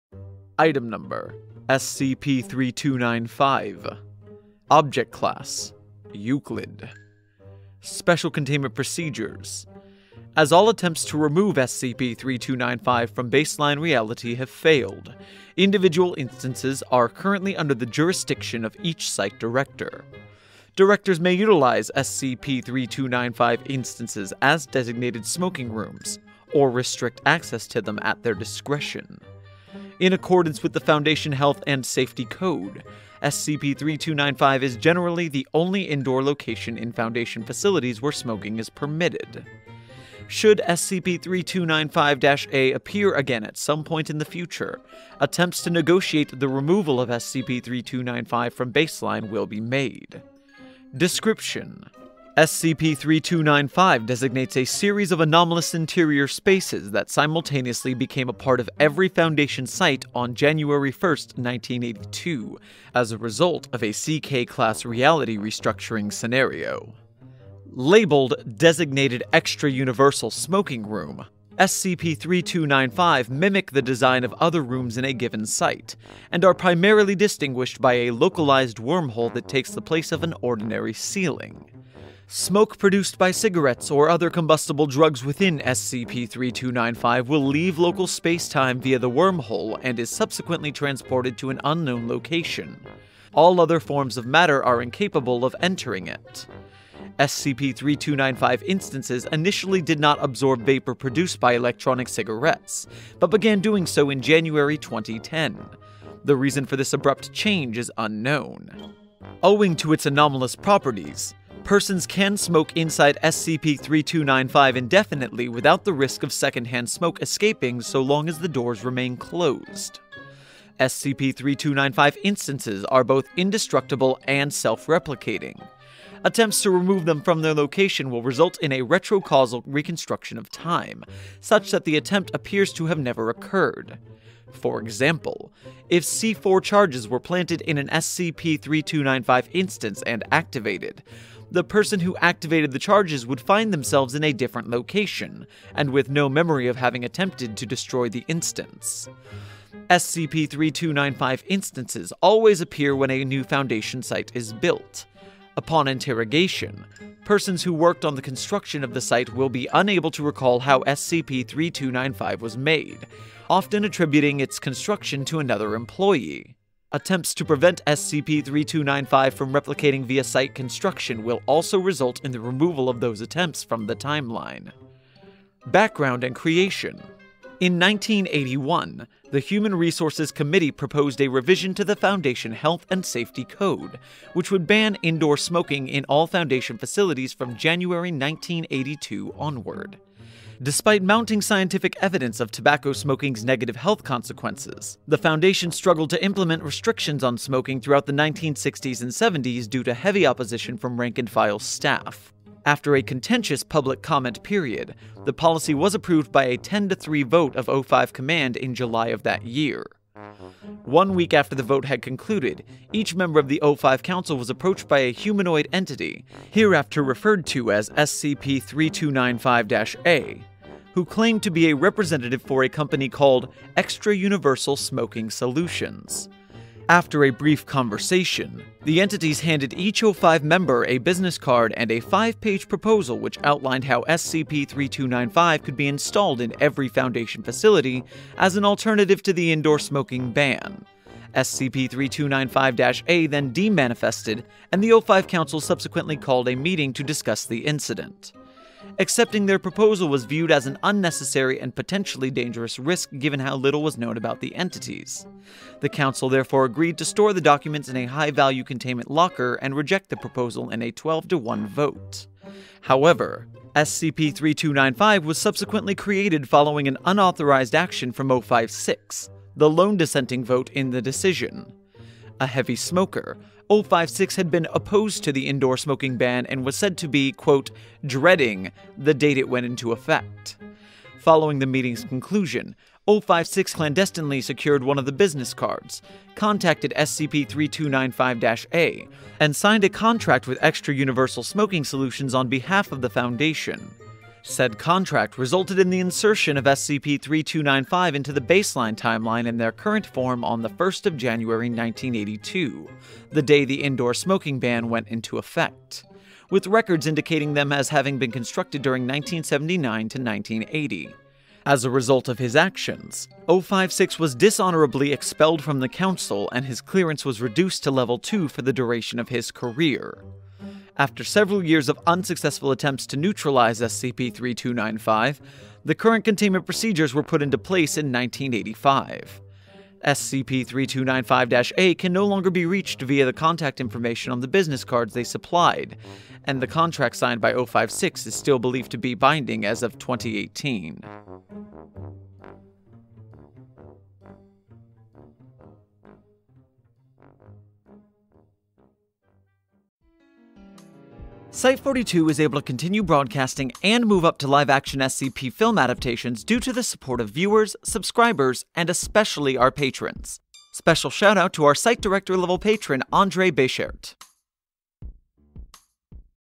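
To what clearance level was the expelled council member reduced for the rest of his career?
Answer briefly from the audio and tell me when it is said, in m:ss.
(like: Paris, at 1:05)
Level 2, at 5:17.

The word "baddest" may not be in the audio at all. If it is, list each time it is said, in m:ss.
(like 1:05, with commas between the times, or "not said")
not said.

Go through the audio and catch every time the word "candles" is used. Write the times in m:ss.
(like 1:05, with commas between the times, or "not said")
not said.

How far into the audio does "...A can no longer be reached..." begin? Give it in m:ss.
5:31.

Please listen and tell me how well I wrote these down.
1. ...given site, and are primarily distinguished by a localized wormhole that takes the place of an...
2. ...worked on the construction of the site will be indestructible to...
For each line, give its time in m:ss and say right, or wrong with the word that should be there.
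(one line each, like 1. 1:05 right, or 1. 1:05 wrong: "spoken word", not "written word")
1. 1:15 right
2. 2:37 wrong: "unable", not "indestructible".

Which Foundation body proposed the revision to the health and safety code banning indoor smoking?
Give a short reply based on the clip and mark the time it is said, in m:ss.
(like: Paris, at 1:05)
Human Resources Committee, at 2:59.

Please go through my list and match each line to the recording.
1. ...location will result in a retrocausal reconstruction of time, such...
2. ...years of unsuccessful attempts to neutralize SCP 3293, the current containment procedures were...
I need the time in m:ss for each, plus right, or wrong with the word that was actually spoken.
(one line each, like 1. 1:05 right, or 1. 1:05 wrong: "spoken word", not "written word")
1. 2:07 right
2. 5:21 wrong: "3295", not "3293".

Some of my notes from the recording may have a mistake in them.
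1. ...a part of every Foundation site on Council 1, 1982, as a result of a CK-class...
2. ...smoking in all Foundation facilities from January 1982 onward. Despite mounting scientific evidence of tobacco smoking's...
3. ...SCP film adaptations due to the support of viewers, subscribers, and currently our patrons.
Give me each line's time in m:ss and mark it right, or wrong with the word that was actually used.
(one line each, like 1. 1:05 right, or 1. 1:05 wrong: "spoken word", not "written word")
1. 0:58 wrong: "January", not "Council"
2. 3:05 right
3. 5:54 wrong: "especially", not "currently".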